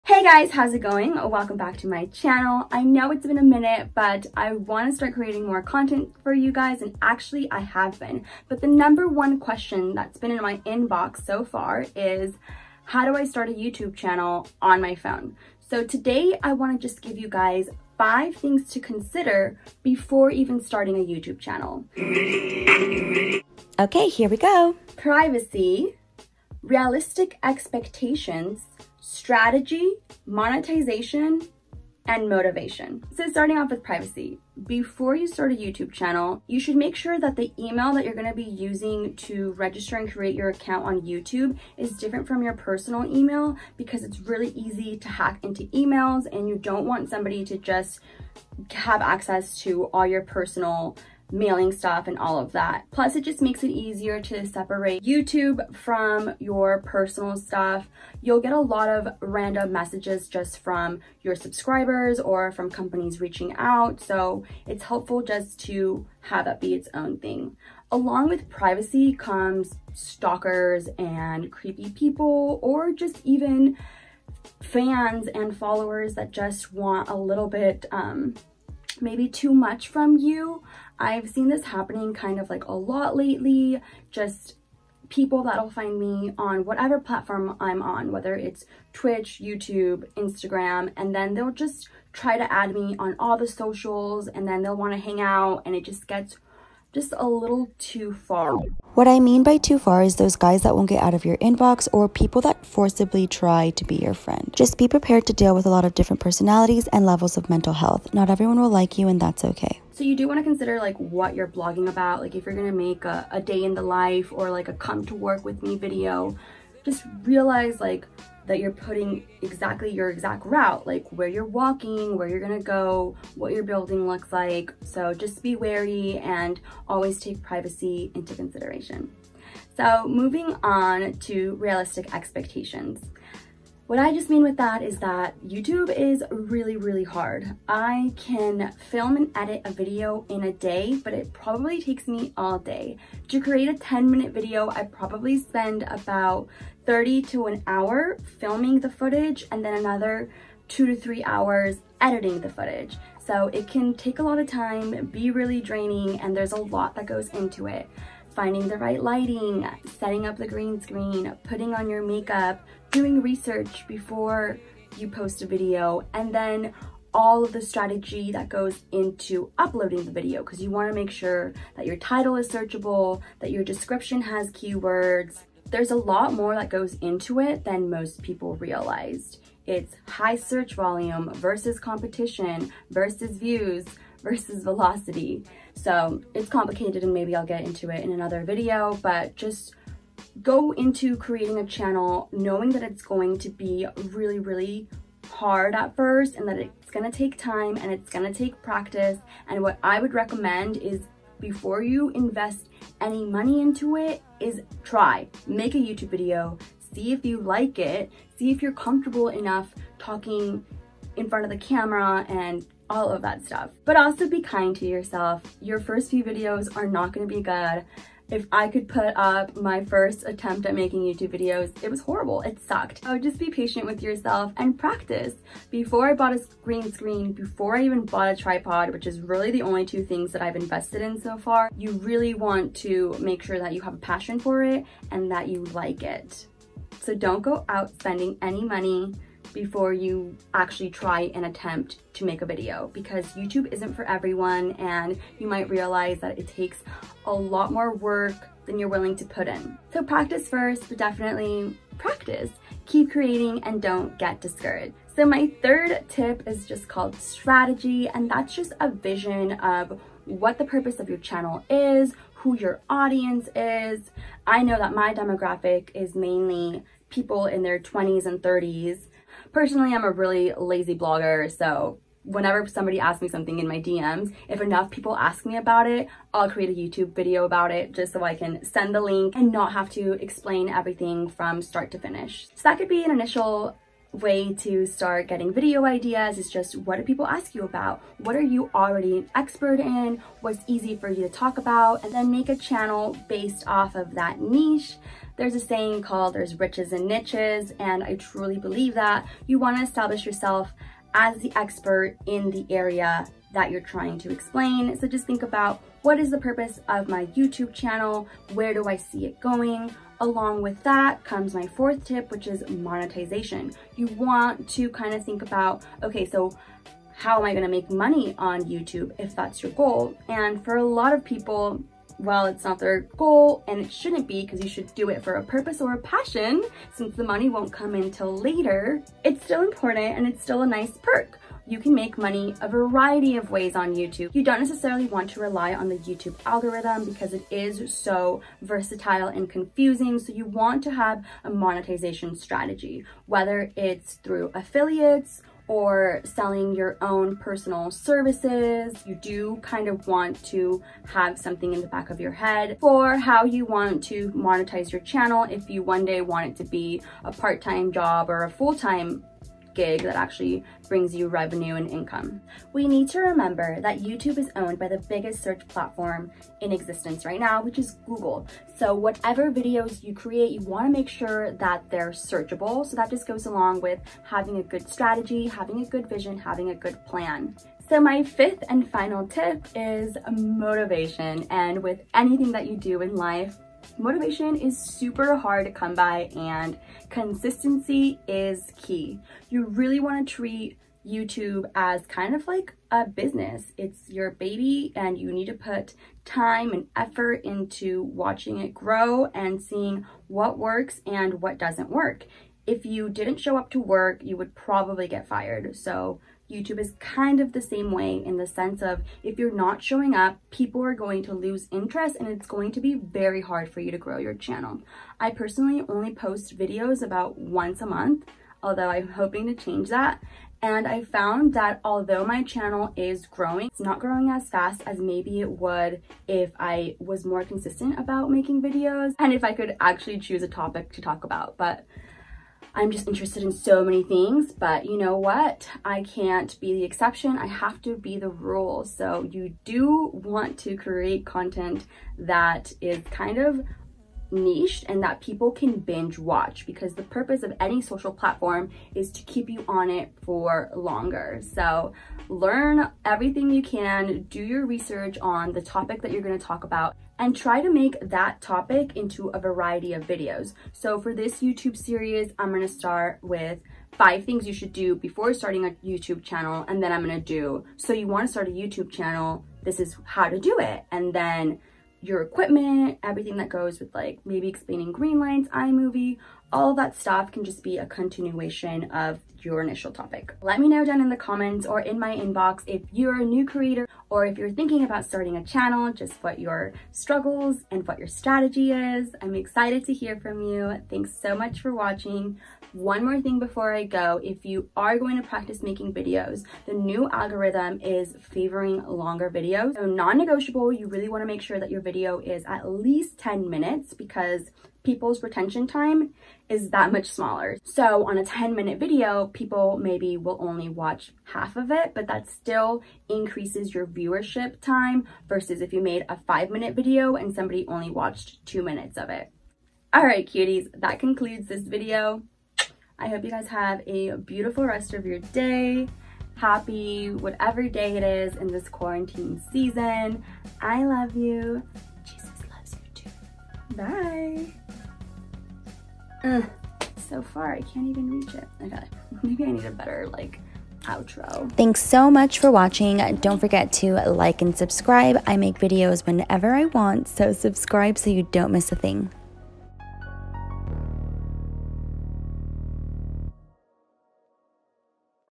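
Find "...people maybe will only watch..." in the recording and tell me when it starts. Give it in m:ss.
8:29.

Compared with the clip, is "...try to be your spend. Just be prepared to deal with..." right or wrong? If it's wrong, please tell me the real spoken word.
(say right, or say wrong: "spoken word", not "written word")
wrong: "friend", not "spend".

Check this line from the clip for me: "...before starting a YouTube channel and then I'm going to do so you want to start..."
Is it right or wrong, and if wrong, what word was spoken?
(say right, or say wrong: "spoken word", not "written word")
right.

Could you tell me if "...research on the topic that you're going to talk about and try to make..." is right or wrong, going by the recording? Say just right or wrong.
right.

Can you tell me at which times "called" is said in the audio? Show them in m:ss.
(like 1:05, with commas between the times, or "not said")
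4:16, 4:56.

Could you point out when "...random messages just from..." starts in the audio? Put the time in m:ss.
0:59.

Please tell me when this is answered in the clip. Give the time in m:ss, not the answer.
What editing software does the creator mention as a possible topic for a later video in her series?
7:55.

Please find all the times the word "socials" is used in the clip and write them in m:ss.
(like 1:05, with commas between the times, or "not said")
1:33, 7:27.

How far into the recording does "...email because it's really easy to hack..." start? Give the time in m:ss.
0:43.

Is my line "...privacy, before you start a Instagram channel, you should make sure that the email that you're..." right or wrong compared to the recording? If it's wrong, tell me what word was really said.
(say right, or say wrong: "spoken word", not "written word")
wrong: "YouTube", not "Instagram".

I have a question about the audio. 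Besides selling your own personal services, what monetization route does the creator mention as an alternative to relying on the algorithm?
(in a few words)
Affiliates.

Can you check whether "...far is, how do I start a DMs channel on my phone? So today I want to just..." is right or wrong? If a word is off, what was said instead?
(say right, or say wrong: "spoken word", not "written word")
wrong: "YouTube", not "DMs".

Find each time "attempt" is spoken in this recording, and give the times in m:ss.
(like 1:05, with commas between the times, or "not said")
3:40, 4:01.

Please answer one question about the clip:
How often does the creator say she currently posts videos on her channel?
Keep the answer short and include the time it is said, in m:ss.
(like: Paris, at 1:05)
About once a month, at 6:57.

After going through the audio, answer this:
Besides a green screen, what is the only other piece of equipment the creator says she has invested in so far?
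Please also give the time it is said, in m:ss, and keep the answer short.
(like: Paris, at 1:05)
Tripod, at 3:48.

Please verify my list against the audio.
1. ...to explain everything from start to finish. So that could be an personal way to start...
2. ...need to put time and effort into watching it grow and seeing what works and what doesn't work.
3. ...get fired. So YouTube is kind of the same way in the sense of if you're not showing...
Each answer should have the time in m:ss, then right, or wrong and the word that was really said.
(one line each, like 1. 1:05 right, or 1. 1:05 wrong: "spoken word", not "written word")
1. 4:39 wrong: "initial", not "personal"
2. 6:35 right
3. 6:45 right.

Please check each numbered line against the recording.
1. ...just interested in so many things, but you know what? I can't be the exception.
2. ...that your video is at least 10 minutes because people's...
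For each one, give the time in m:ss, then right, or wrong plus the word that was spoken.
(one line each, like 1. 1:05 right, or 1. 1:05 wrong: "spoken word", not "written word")
1. 7:12 right
2. 8:21 right.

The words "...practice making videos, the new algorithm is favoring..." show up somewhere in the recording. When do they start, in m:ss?
8:15.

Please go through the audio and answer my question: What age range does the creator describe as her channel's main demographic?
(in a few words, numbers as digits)
20s and 30s.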